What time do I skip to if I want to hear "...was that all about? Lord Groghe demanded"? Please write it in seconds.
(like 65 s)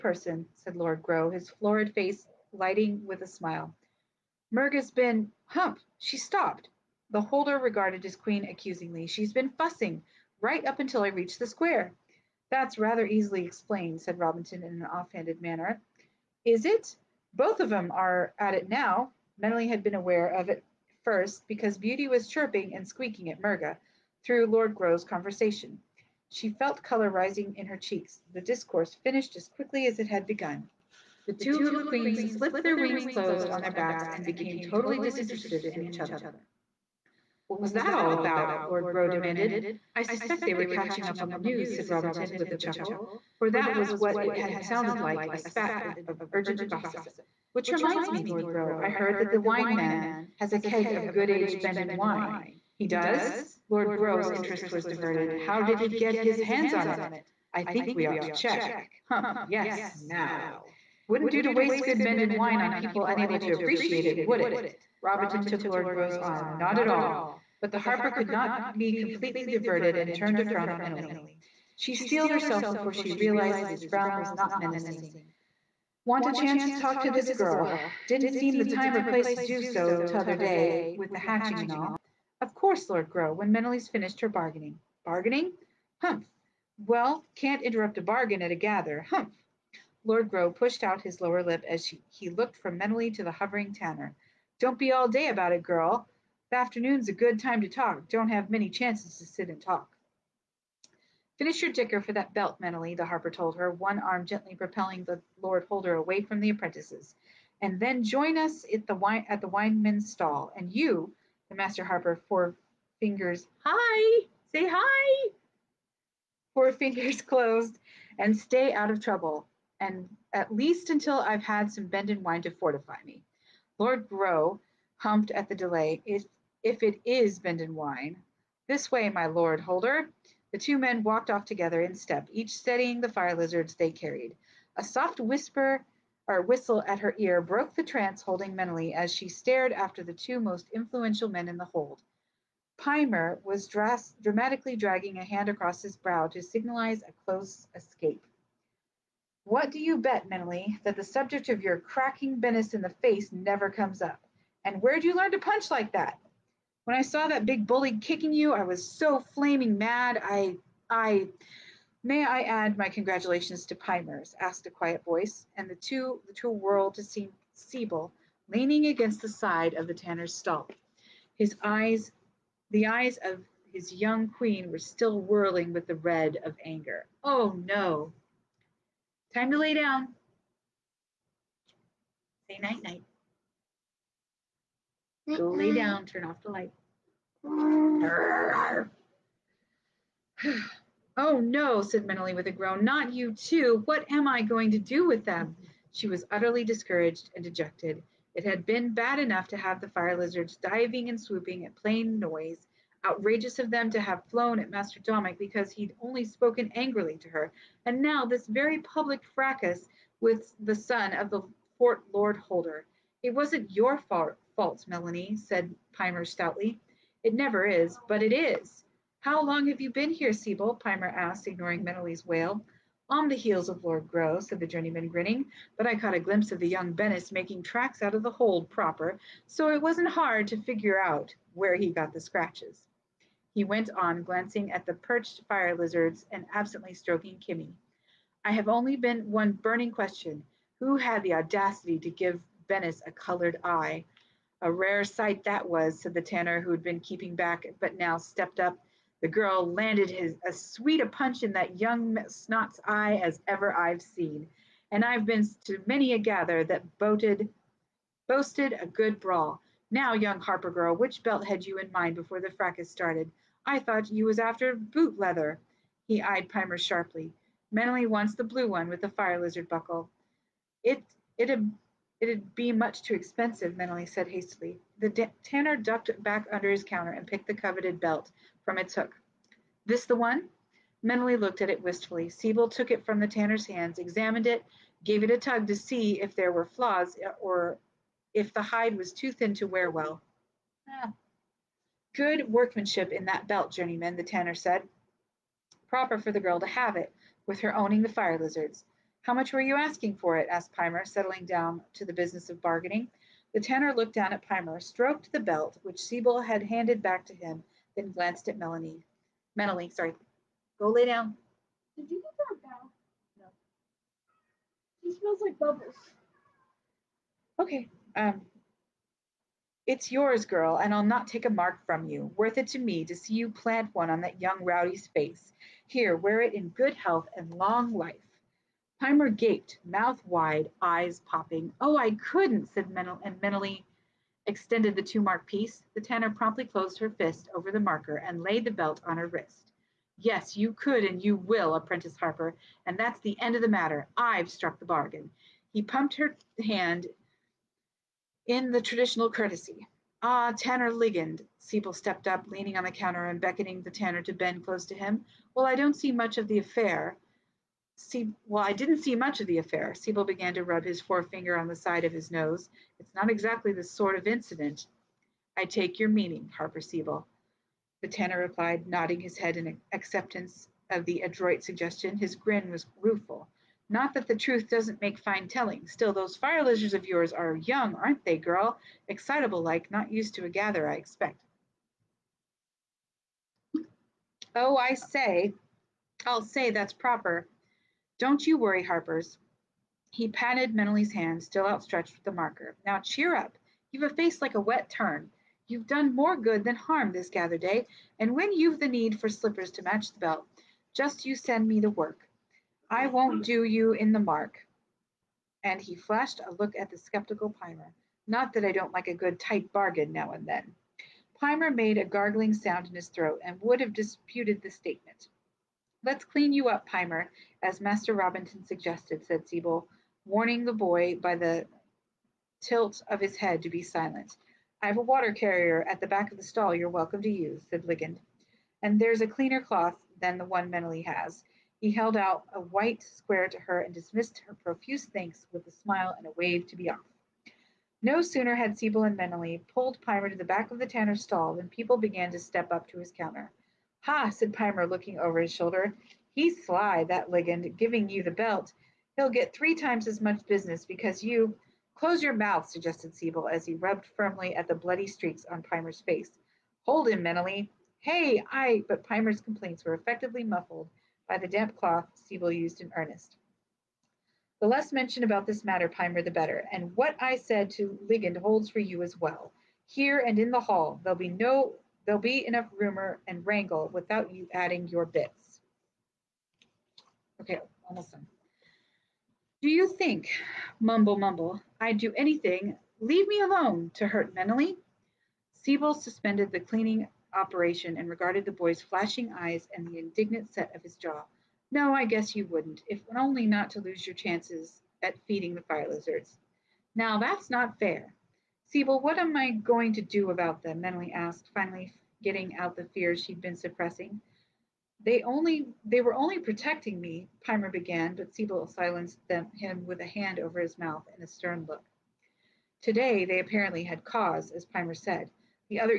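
37 s.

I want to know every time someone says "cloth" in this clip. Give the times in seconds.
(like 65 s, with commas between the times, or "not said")
429 s, 461 s.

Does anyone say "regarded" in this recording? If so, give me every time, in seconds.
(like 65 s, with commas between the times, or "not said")
7 s, 488 s.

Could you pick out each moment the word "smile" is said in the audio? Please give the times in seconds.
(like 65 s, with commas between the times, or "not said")
3 s, 435 s.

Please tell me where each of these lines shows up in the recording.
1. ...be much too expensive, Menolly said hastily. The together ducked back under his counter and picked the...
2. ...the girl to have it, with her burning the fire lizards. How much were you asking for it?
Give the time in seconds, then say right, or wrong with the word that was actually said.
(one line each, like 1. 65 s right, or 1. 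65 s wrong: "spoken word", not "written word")
1. 272 s wrong: "tanner", not "together"
2. 296 s wrong: "owning", not "burning".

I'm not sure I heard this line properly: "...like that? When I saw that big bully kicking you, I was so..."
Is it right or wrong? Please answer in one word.
right.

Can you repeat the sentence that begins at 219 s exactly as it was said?
How long have you been here, Sebell?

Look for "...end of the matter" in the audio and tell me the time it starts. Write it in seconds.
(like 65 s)
343 s.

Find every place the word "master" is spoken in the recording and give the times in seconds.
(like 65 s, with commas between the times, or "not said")
111 s, 204 s, 417 s.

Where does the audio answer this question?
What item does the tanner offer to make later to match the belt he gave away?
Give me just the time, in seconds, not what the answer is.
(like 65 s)
399 s.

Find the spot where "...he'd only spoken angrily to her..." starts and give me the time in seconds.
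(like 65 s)
205 s.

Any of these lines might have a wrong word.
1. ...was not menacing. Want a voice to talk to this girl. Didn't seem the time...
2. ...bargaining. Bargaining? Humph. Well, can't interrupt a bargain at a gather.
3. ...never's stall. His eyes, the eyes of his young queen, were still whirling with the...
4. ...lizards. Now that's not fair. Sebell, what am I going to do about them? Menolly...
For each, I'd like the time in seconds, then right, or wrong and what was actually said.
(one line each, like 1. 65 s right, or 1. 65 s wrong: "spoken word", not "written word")
1. 74 s wrong: "chance", not "voice"
2. 84 s right
3. 169 s wrong: "tanner", not "never"
4. 495 s right.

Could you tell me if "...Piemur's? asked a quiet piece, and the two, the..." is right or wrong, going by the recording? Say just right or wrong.
wrong.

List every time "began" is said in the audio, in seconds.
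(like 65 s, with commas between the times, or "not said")
360 s, 441 s, 507 s.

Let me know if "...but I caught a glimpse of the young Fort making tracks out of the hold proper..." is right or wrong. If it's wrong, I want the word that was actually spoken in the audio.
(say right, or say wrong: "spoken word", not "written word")
wrong: "Bennis", not "Fort".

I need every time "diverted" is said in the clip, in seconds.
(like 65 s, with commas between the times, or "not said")
54 s, 69 s.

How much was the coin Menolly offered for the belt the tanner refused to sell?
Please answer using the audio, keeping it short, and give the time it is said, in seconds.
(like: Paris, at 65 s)
2 marks, at 335 s.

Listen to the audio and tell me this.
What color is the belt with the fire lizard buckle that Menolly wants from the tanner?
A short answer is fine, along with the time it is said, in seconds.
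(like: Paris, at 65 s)
blue, at 268 s.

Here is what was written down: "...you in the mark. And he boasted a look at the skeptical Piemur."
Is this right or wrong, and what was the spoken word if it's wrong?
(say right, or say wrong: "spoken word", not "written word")
wrong: "flashed", not "boasted".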